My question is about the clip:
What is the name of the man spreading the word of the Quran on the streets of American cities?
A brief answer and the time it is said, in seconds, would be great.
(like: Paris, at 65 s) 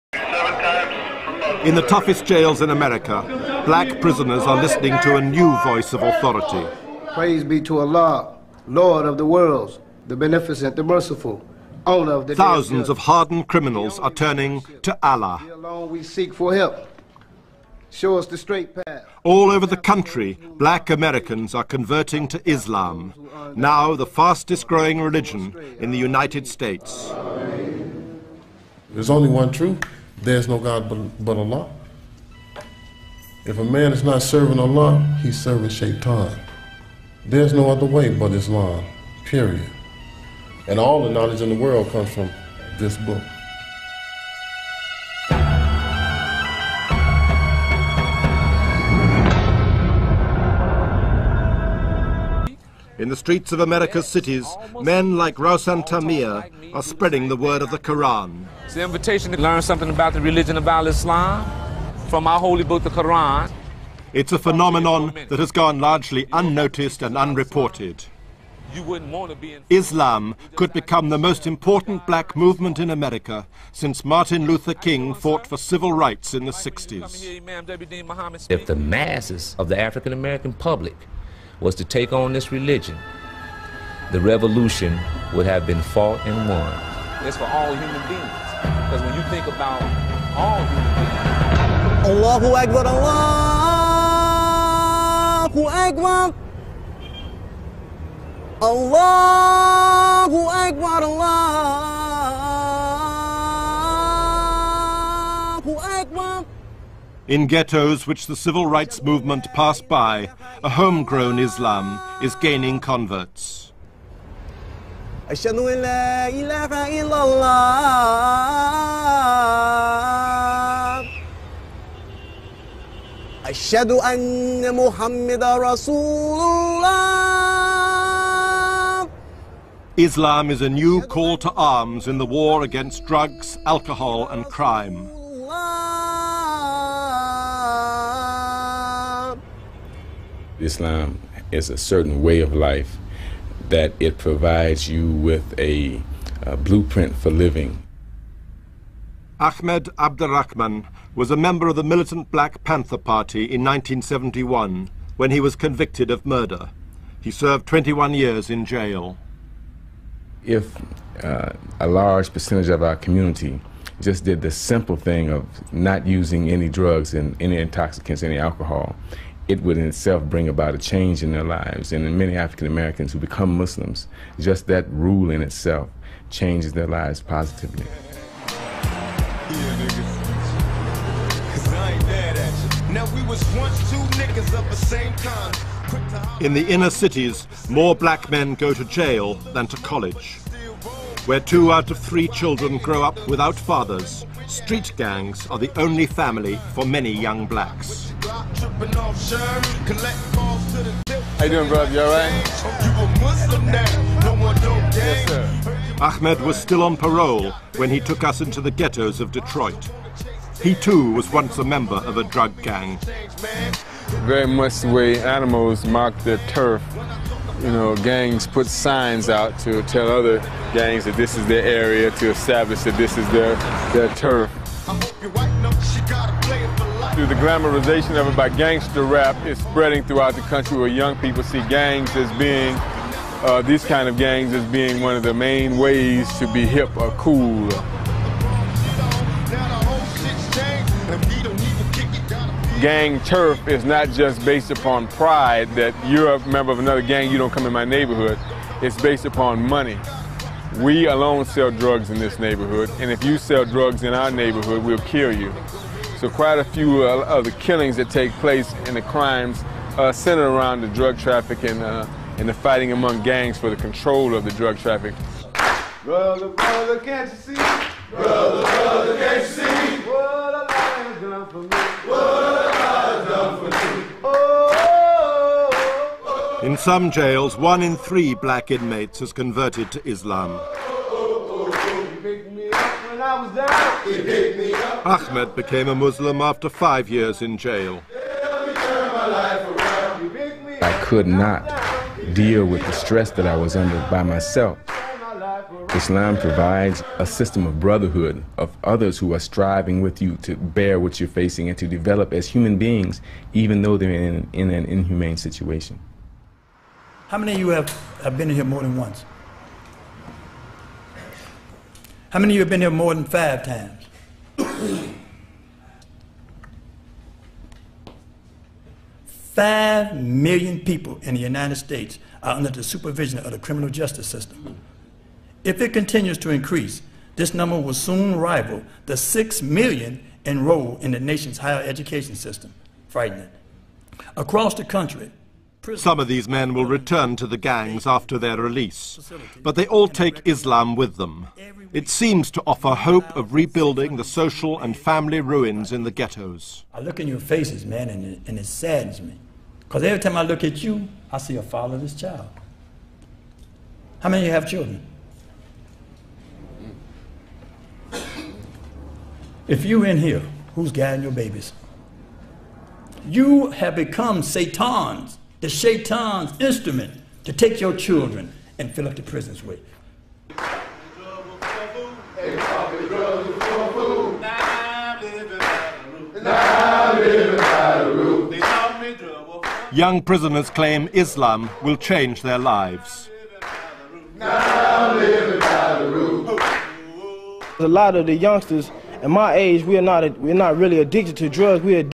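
Rausan Tamir, at 55 s.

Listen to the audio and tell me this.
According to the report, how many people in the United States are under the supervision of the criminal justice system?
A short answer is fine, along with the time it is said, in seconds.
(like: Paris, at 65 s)
5 million, at 319 s.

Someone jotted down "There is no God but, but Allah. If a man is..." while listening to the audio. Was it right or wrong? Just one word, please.
right.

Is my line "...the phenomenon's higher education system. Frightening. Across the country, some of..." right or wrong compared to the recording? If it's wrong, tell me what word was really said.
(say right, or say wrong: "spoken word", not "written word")
wrong: "nation", not "phenomenon".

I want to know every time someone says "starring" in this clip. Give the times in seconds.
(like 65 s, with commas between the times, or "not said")
not said.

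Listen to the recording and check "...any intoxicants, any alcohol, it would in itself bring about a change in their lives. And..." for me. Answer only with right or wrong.
right.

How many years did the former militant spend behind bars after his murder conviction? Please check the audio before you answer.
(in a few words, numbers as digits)
21.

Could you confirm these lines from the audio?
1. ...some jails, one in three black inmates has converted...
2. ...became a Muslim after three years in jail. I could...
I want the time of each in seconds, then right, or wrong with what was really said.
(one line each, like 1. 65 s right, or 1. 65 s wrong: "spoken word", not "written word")
1. 276 s right
2. 285 s wrong: "five", not "three".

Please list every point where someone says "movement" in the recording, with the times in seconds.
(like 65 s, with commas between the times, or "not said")
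72 s, 109 s.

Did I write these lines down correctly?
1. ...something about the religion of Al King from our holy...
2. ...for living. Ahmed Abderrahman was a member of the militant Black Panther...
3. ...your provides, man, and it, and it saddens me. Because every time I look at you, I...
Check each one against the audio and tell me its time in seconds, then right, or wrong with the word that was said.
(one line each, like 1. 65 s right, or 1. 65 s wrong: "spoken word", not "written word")
1. 59 s wrong: "Islam", not "King"
2. 147 s right
3. 347 s wrong: "faces", not "provides".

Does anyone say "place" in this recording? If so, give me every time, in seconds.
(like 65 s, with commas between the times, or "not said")
258 s.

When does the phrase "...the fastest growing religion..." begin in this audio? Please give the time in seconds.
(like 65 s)
23 s.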